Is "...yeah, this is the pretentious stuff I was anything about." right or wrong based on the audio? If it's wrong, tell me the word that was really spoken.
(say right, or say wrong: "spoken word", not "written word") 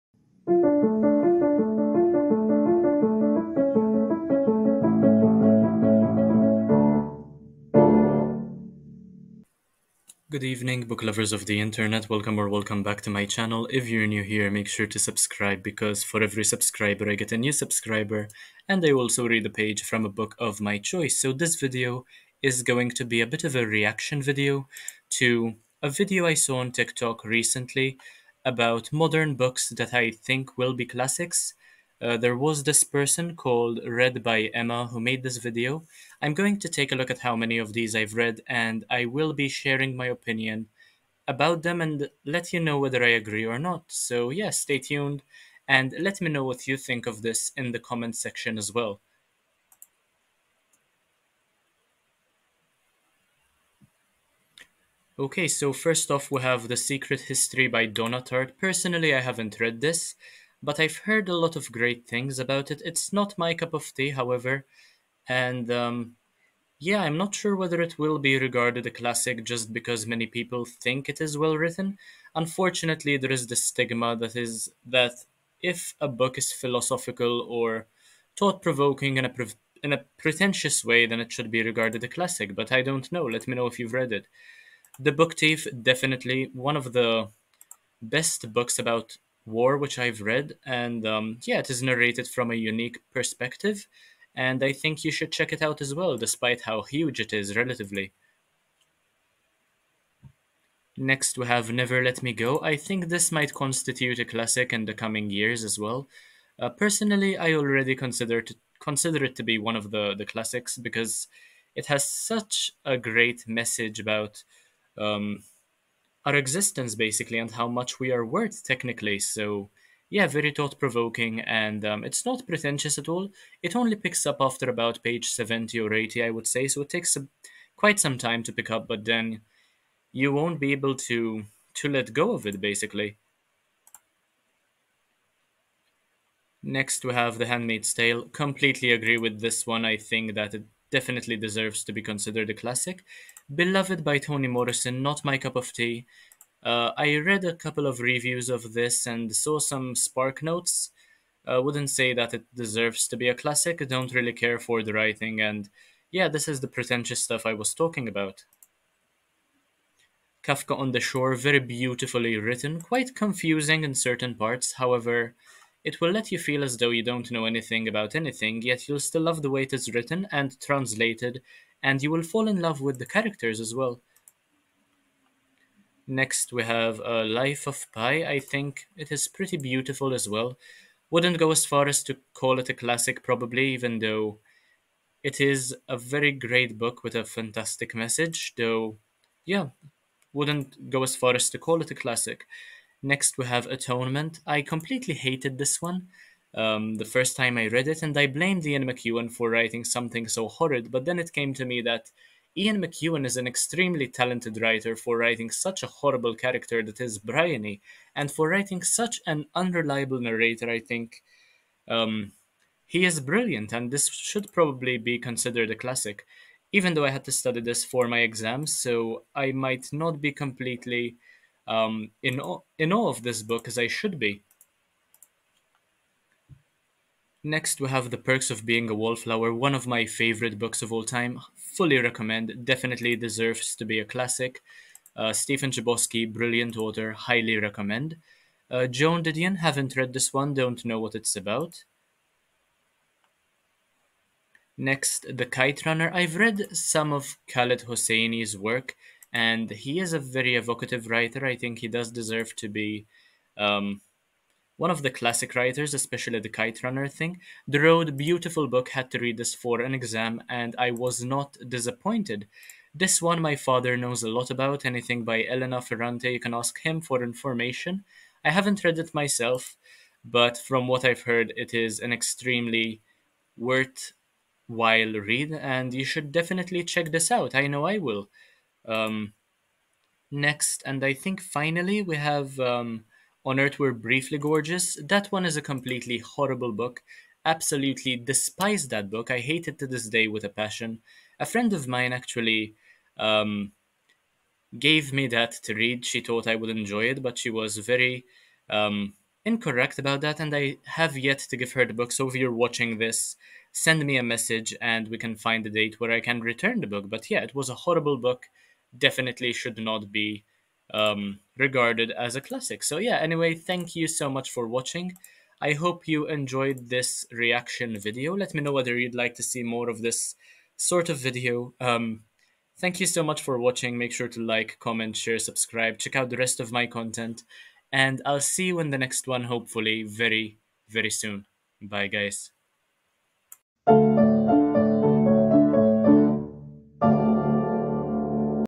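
wrong: "talking", not "anything".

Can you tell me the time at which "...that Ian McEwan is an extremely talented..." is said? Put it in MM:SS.
03:21.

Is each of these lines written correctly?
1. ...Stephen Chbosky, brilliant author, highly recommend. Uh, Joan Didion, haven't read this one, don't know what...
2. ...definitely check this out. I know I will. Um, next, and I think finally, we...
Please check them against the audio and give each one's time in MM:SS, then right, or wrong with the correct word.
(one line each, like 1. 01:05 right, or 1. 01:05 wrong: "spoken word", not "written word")
1. 03:55 right
2. 04:36 right.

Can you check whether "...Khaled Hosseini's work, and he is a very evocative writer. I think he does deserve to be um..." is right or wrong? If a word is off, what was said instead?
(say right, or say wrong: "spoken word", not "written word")
right.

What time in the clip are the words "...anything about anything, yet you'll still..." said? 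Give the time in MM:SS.
02:47.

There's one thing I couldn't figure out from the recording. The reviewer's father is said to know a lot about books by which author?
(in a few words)
Elena Ferrante.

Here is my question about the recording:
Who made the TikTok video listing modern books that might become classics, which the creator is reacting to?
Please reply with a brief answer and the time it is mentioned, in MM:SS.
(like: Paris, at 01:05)
Read by Emma, at 00:33.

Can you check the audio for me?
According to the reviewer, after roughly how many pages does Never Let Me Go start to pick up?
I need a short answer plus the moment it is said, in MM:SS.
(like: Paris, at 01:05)
70 or 80, at 02:05.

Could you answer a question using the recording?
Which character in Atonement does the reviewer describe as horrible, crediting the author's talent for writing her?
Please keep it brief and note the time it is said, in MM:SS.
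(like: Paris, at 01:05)
Bryony, at 03:27.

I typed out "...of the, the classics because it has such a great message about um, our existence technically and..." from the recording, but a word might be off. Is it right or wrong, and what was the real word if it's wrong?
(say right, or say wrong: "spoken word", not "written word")
wrong: "basically", not "technically".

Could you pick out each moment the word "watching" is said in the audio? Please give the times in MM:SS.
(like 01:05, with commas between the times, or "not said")
05:02, 05:14, 05:23.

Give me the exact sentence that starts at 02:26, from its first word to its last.
Uh, I read a couple of reviews of this and saw some spark notes.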